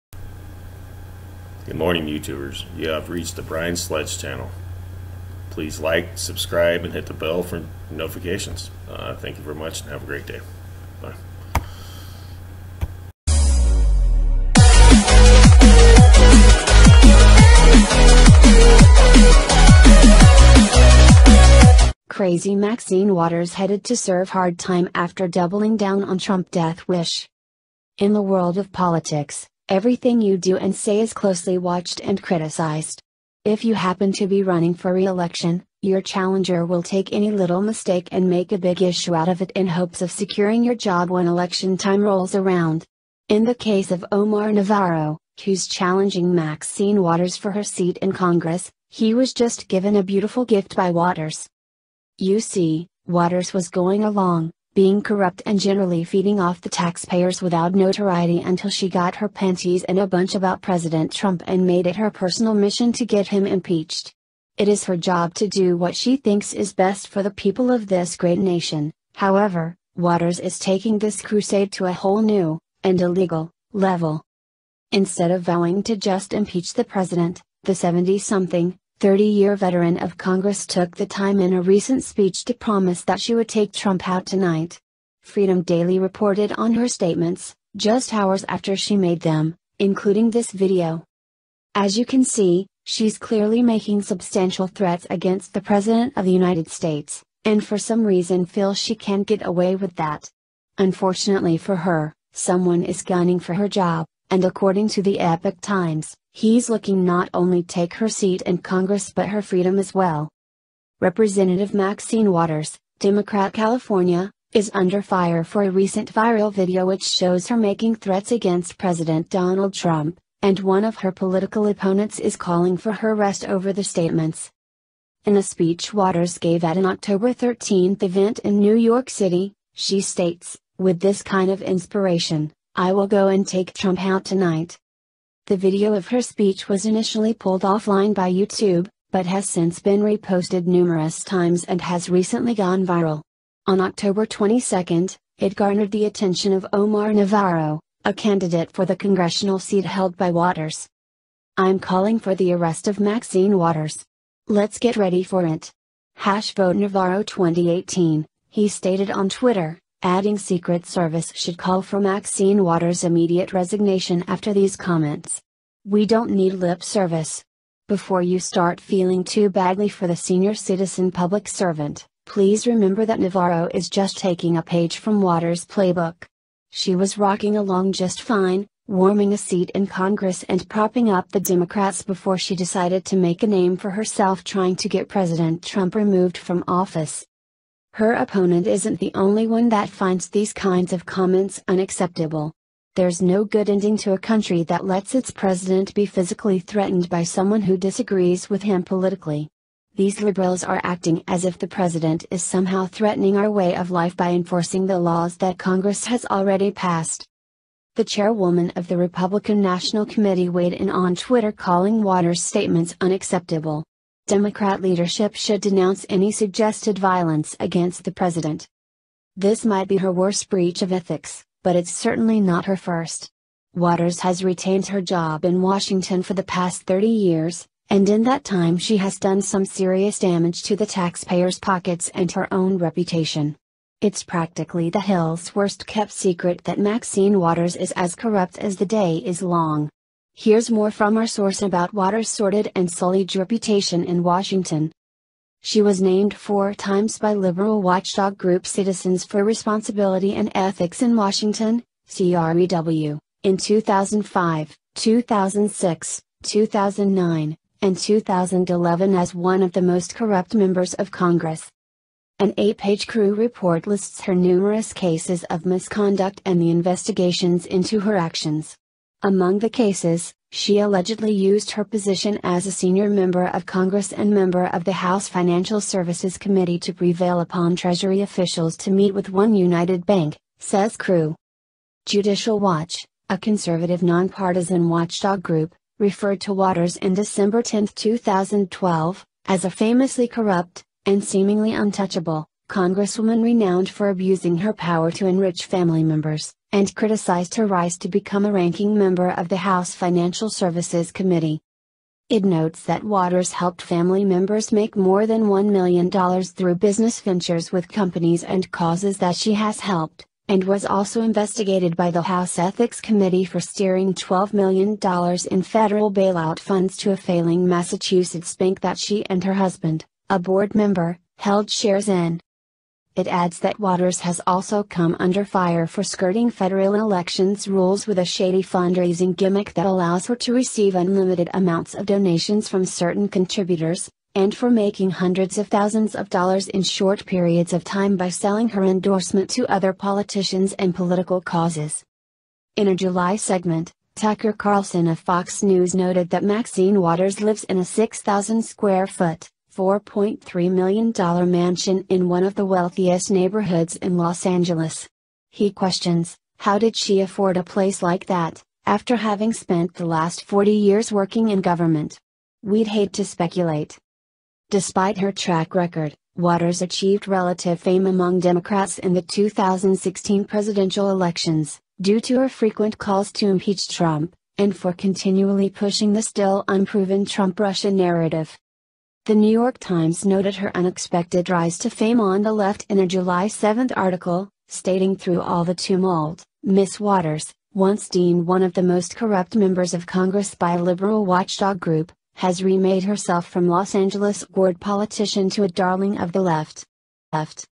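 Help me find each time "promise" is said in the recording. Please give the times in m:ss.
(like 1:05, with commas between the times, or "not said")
1:22.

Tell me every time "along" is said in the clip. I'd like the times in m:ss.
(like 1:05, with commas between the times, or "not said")
0:54, 2:57.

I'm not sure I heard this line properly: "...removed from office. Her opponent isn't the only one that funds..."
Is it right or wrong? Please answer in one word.
wrong.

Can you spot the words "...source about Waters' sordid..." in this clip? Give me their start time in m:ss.
4:01.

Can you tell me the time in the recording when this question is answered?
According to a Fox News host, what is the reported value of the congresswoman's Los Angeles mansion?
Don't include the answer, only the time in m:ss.
5:49.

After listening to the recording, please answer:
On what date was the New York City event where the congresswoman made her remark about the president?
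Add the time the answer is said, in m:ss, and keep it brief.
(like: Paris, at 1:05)
October 13, at 2:06.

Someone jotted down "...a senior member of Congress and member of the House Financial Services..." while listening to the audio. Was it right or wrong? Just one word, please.
right.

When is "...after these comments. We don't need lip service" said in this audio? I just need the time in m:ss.
2:44.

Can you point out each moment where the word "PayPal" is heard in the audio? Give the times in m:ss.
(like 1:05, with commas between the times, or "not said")
not said.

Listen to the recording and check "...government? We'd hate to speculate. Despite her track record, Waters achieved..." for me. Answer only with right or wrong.
right.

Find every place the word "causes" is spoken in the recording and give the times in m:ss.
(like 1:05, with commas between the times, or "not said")
5:08, 5:41.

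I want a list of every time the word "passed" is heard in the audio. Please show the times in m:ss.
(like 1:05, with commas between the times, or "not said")
3:26.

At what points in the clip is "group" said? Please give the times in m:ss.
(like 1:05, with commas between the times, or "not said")
4:08, 4:45, 6:31.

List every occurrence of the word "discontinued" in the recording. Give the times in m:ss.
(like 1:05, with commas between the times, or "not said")
not said.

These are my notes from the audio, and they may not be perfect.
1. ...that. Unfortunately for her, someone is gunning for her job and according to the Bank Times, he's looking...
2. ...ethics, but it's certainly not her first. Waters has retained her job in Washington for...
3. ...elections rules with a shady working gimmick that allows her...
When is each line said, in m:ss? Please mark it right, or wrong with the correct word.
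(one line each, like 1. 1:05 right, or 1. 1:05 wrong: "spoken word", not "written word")
1. 1:39 wrong: "Epoch", not "Bank"
2. 3:40 right
3. 5:26 wrong: "fundraising", not "working".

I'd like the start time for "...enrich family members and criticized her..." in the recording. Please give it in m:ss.
4:55.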